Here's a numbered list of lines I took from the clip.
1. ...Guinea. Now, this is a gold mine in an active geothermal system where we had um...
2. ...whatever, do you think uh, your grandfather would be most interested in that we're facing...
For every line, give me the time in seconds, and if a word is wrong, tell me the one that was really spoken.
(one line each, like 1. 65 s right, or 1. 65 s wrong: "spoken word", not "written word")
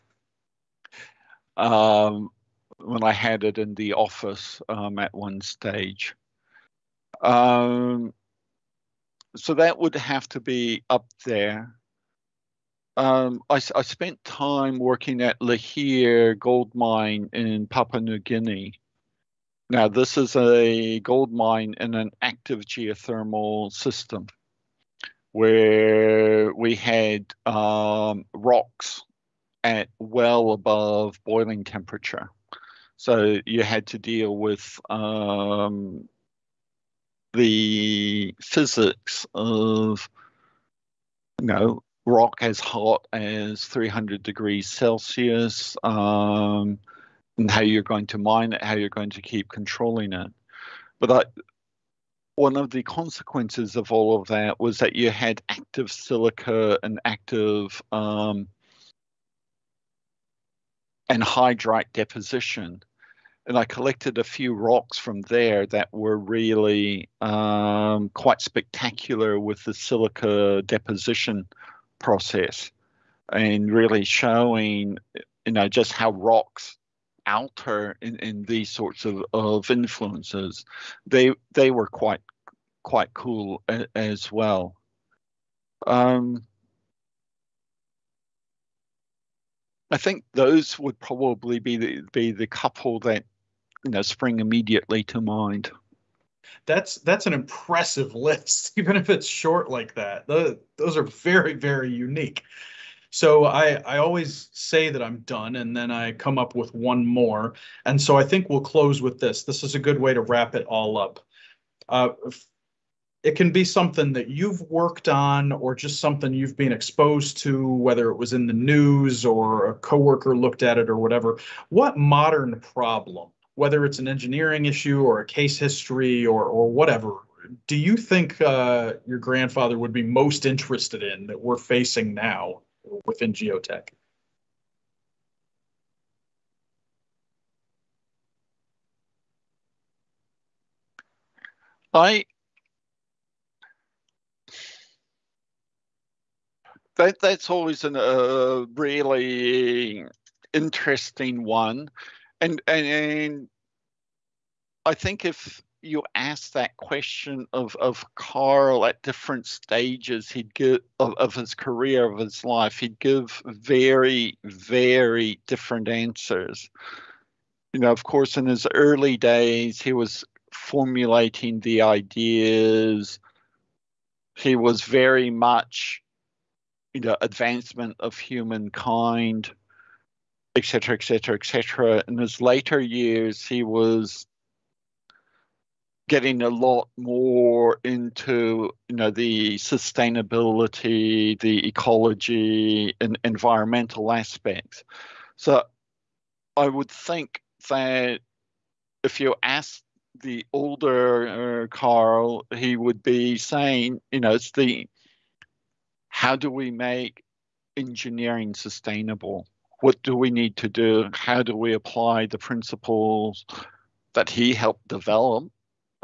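1. 18 s right
2. 126 s right.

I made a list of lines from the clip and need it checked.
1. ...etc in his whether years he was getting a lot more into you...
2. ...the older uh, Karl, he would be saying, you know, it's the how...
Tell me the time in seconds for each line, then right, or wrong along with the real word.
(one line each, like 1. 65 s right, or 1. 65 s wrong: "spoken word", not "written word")
1. 181 s wrong: "later", not "whether"
2. 200 s right.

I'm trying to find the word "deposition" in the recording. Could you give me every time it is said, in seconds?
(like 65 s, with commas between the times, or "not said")
61 s, 70 s.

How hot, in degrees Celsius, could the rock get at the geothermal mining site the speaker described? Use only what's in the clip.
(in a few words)
300 degrees Celsius.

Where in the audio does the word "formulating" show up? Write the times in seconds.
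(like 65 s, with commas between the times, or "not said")
170 s.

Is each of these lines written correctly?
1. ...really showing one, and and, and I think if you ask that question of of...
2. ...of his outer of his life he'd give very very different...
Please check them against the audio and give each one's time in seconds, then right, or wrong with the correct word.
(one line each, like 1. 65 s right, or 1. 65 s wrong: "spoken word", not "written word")
1. 148 s wrong: "interesting", not "showing"
2. 161 s wrong: "career", not "outer".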